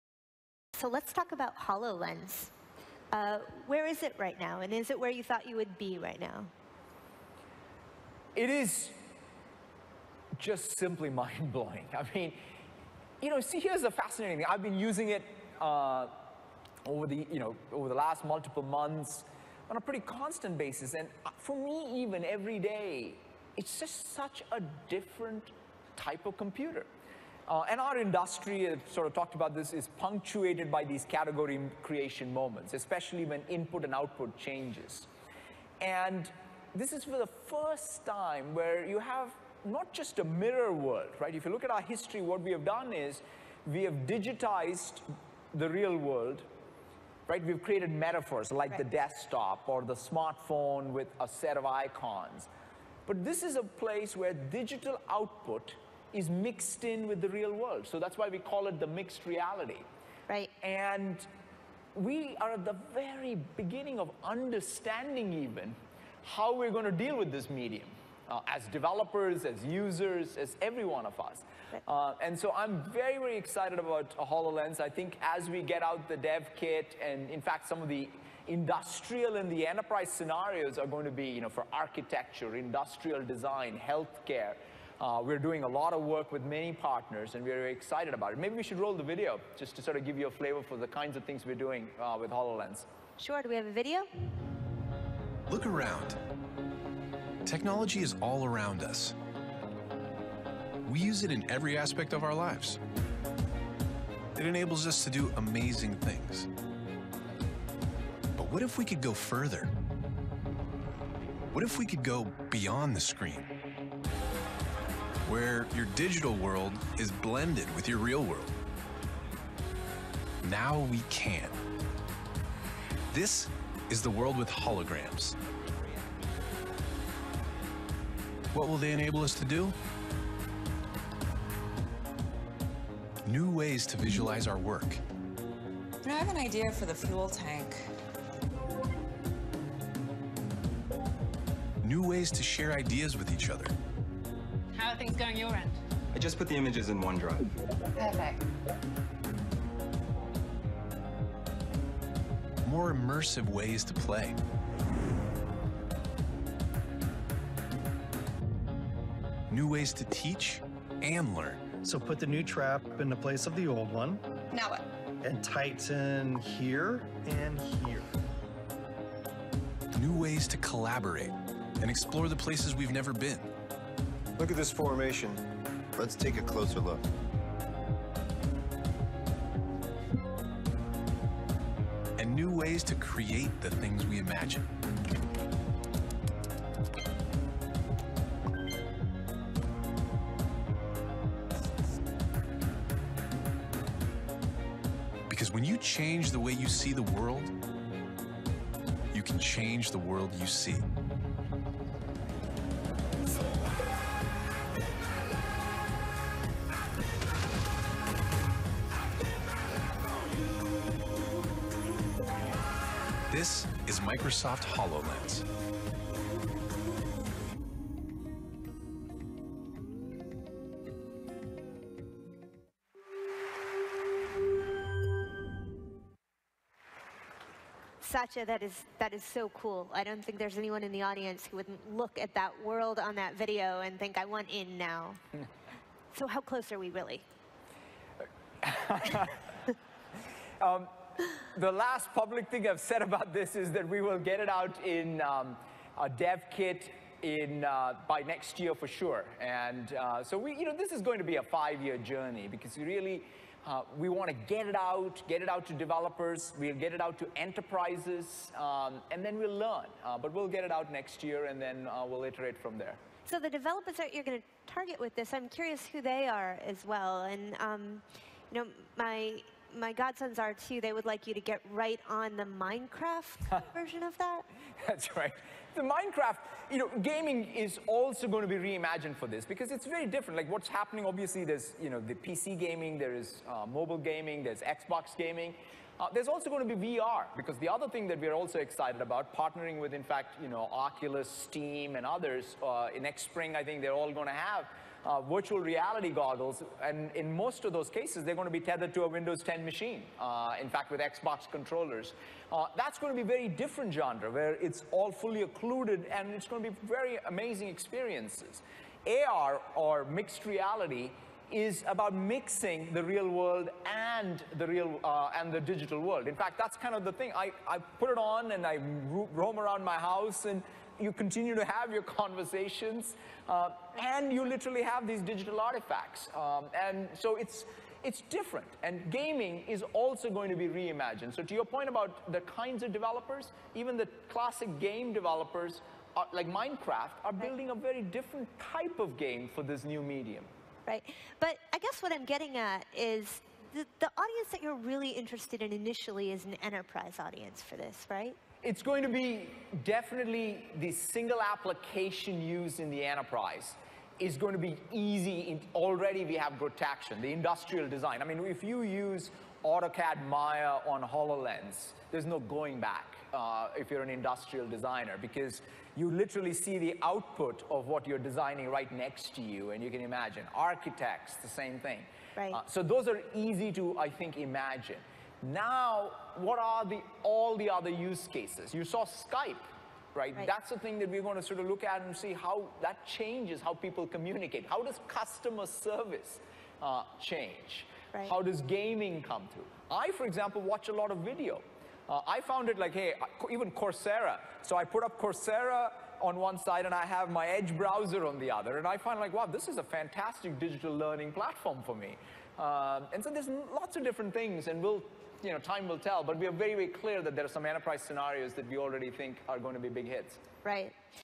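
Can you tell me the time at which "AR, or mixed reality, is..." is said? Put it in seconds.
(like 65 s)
309 s.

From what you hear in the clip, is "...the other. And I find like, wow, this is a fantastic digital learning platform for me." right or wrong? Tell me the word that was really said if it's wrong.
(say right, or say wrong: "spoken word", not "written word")
right.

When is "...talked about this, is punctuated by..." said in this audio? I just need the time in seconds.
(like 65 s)
29 s.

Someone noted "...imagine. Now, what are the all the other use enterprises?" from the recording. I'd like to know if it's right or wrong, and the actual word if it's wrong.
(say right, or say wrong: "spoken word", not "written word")
wrong: "cases", not "enterprises".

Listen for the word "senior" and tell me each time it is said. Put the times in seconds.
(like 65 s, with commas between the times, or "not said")
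not said.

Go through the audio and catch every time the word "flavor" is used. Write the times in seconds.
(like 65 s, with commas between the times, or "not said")
90 s.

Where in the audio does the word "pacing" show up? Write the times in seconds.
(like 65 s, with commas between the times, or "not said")
not said.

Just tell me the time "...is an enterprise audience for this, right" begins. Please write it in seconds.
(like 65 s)
346 s.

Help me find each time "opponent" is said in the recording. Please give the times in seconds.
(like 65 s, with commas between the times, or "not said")
not said.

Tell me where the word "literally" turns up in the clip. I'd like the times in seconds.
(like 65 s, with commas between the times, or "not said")
324 s, 366 s.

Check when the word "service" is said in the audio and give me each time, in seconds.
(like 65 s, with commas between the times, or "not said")
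385 s.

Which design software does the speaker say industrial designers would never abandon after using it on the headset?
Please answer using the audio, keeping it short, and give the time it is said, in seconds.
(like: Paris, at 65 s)
AutoCAD Maya, at 359 s.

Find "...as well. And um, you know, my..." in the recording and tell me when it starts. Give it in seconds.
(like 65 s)
266 s.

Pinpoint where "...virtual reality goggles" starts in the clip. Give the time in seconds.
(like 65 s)
295 s.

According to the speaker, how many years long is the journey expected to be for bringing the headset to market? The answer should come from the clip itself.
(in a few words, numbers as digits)
5.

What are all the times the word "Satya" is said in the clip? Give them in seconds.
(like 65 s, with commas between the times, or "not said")
228 s.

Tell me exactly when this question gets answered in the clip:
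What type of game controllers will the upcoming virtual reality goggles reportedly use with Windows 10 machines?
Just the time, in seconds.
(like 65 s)
301 s.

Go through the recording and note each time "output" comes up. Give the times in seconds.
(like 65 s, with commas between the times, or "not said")
33 s, 55 s, 367 s.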